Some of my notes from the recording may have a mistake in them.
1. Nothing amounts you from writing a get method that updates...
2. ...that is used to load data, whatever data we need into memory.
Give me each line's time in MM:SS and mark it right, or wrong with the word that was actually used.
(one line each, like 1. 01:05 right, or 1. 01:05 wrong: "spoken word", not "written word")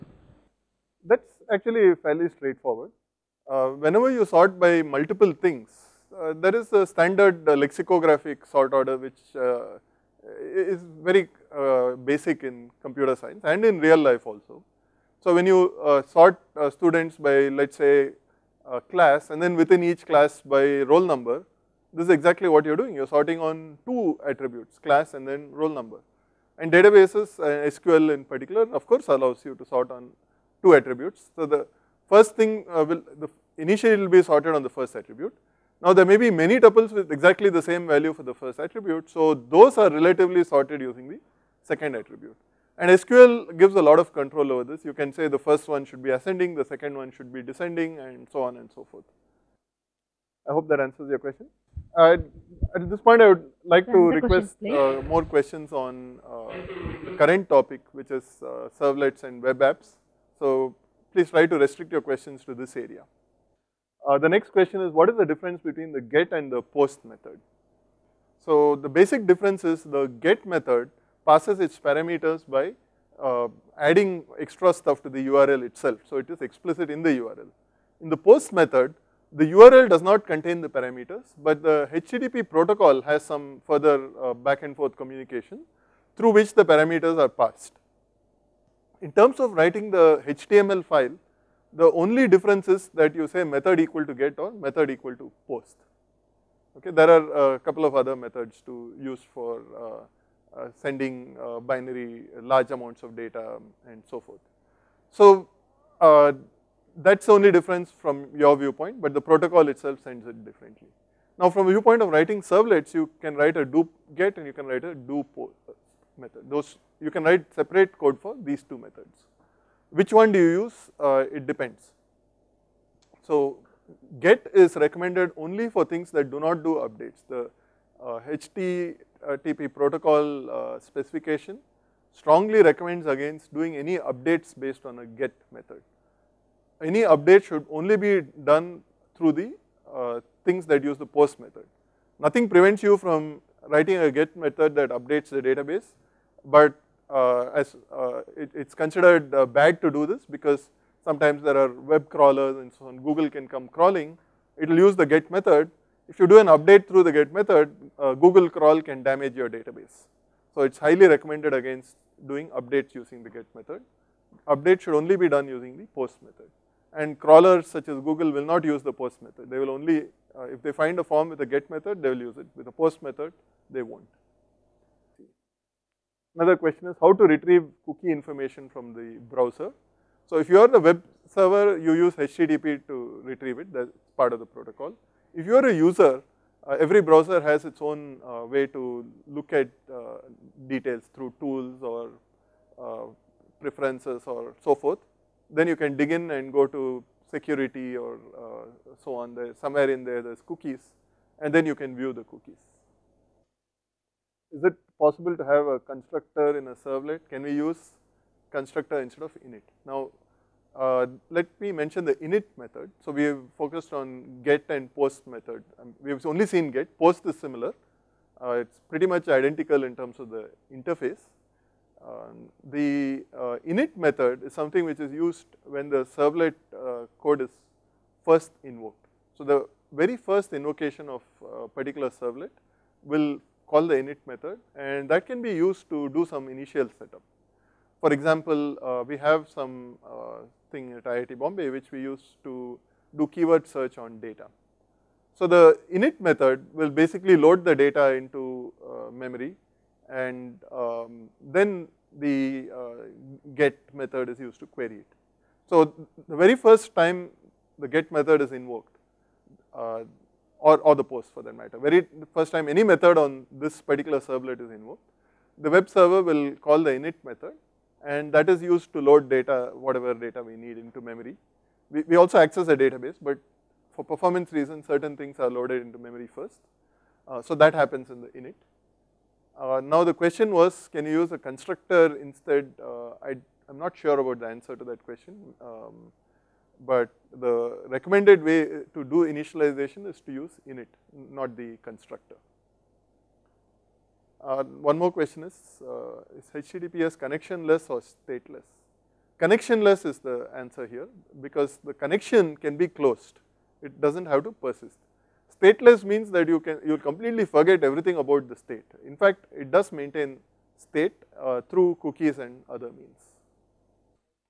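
1. 02:22 wrong: "prevents", not "amounts"
2. 04:28 right.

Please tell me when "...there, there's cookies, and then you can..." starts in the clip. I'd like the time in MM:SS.
03:20.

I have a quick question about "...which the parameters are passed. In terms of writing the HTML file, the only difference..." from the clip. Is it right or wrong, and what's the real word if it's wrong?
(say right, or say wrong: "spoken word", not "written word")
right.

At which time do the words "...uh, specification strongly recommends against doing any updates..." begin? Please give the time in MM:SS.
02:10.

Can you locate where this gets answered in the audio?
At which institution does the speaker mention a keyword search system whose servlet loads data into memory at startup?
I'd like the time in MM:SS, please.
04:01.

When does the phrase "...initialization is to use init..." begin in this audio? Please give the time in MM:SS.
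04:49.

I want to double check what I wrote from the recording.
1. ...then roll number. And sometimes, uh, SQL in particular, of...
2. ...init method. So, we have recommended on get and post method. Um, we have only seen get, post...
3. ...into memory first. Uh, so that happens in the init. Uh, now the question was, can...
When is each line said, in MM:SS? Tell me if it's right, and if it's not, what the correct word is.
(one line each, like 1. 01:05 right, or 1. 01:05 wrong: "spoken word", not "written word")
1. 00:25 wrong: "databases", not "sometimes"
2. 03:32 wrong: "focused", not "recommended"
3. 04:35 right.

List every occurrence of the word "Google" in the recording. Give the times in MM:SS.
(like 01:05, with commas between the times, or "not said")
02:32, 02:38, 02:47.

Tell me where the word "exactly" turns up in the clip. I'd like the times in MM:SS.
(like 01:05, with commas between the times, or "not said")
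00:22, 00:37.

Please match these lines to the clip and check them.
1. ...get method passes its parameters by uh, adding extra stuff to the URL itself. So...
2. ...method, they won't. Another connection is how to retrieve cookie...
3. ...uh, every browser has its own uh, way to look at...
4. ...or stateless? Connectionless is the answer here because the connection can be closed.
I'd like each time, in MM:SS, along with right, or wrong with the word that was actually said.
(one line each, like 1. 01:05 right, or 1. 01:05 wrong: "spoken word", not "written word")
1. 01:10 right
2. 02:53 wrong: "question", not "connection"
3. 03:06 right
4. 04:57 right.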